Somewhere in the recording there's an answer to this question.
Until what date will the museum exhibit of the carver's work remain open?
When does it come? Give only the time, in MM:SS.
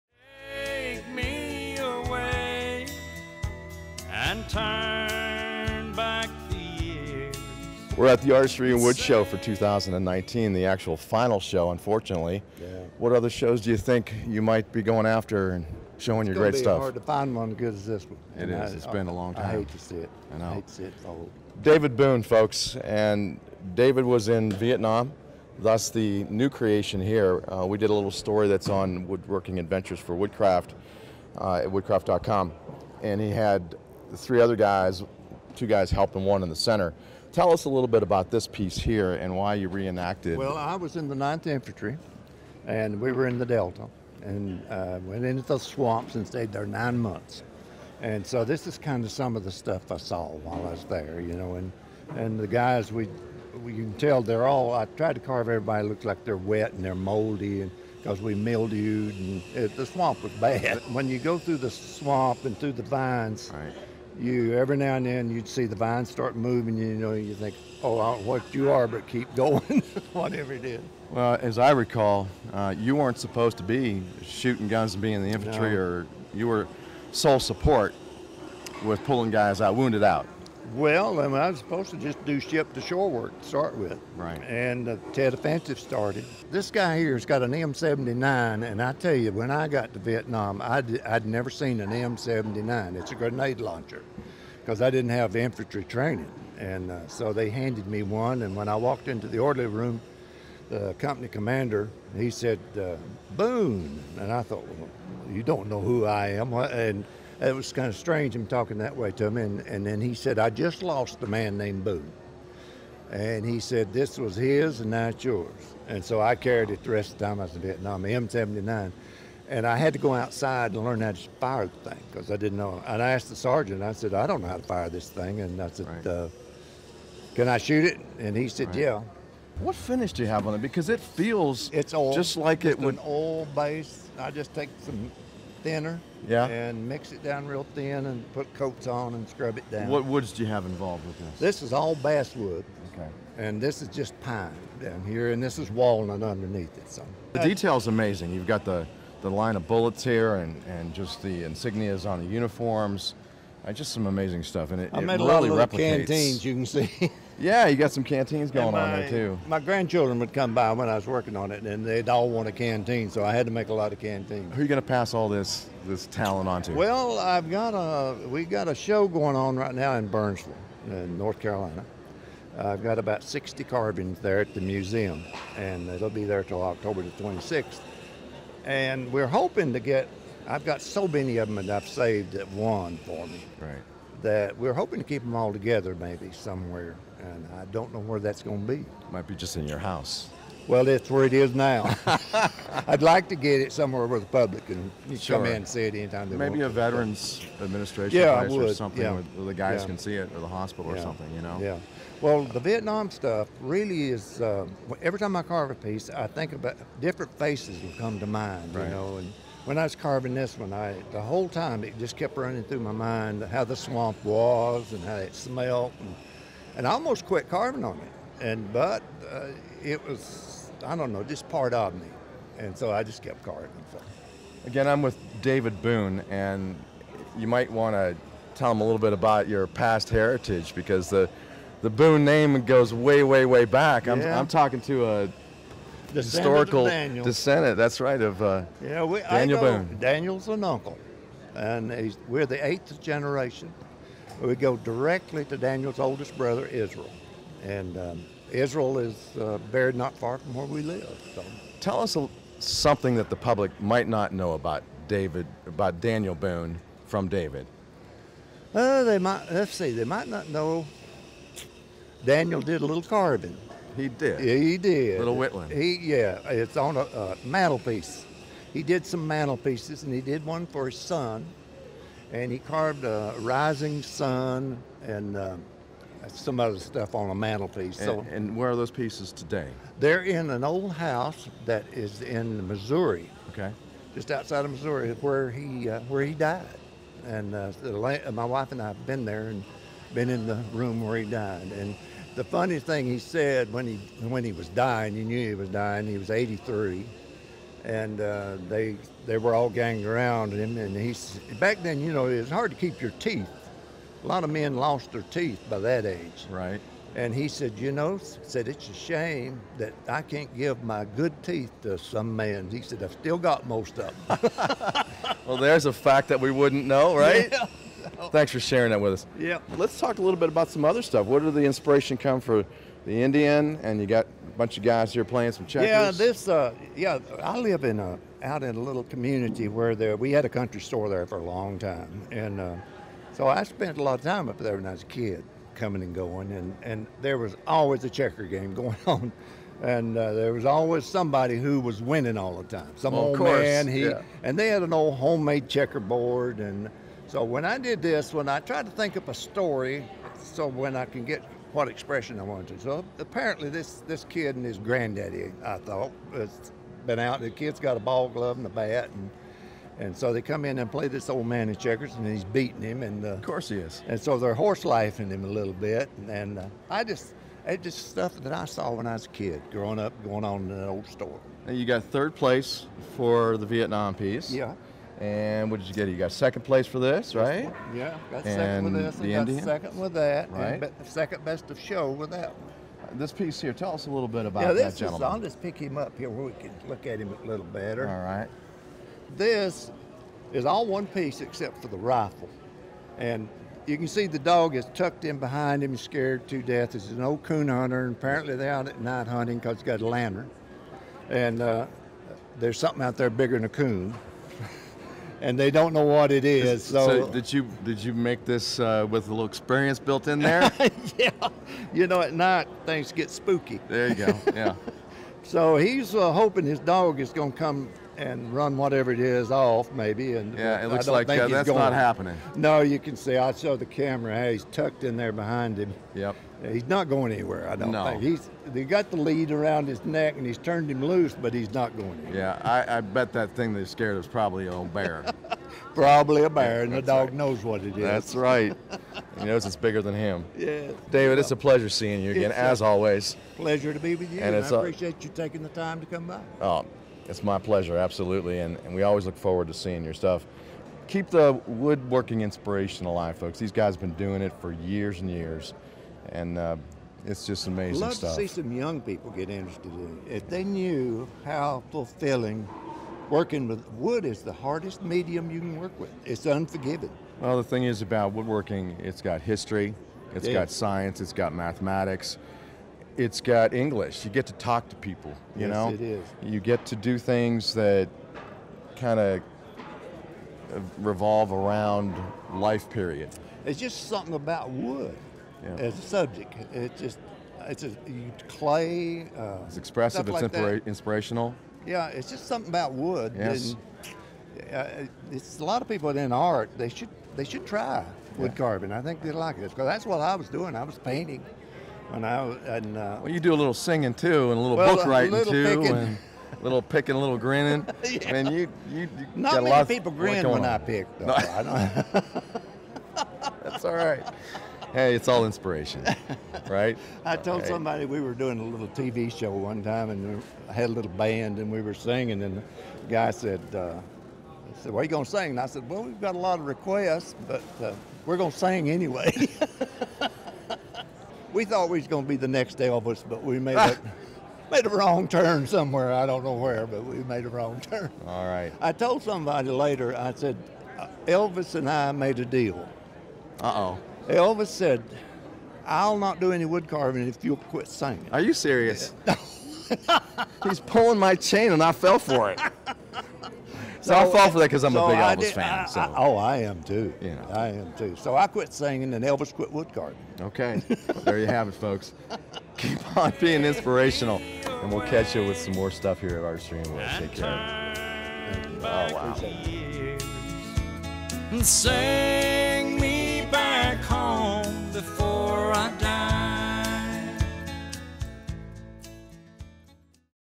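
02:56.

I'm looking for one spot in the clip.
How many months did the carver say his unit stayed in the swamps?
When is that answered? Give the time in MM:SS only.
00:46.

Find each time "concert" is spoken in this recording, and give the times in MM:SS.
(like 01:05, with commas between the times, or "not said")
not said.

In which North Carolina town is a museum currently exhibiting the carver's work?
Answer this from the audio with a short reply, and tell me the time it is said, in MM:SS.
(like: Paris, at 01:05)
Burnsville, at 02:50.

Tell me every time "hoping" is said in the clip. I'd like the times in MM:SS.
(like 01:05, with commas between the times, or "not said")
02:59, 03:04, 06:56.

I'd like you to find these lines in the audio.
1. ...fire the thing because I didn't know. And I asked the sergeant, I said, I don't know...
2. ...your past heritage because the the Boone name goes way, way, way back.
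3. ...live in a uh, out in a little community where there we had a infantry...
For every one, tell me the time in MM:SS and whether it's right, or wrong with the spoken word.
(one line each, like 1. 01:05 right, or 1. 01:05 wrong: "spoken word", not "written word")
1. 02:01 right
2. 03:49 right
3. 05:27 wrong: "country", not "infantry".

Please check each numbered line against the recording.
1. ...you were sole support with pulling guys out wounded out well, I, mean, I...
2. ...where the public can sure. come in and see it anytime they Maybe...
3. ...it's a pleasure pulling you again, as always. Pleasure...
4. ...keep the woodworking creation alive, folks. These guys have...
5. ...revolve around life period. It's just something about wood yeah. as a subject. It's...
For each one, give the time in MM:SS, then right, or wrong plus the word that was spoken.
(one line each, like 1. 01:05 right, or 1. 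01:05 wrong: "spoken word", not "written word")
1. 01:16 right
2. 03:14 right
3. 07:21 wrong: "seeing", not "pulling"
4. 07:31 wrong: "inspiration", not "creation"
5. 08:00 right.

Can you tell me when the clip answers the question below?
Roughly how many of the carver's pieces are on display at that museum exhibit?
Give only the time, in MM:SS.
02:52.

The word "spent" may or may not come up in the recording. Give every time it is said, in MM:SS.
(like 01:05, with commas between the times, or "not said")
05:33.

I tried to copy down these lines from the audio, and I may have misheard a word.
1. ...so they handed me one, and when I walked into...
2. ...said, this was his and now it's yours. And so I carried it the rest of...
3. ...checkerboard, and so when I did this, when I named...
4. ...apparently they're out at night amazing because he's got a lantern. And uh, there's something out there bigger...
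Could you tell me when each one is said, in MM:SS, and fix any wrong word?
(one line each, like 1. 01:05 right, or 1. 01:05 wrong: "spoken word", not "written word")
1. 01:37 right
2. 01:53 right
3. 05:45 wrong: "tried", not "named"
4. 06:38 wrong: "hunting", not "amazing".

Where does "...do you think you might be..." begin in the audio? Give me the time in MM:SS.
00:13.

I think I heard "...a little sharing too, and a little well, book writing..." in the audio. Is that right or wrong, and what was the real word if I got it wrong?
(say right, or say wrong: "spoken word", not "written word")
wrong: "singing", not "sharing".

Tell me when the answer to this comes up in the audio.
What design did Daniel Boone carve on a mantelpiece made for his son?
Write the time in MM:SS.
04:33.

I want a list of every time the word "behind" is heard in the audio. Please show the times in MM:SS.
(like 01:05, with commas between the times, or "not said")
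06:35, 07:05.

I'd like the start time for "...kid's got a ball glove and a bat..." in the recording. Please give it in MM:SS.
05:57.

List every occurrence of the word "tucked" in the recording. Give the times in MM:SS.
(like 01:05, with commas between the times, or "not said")
06:34, 07:04.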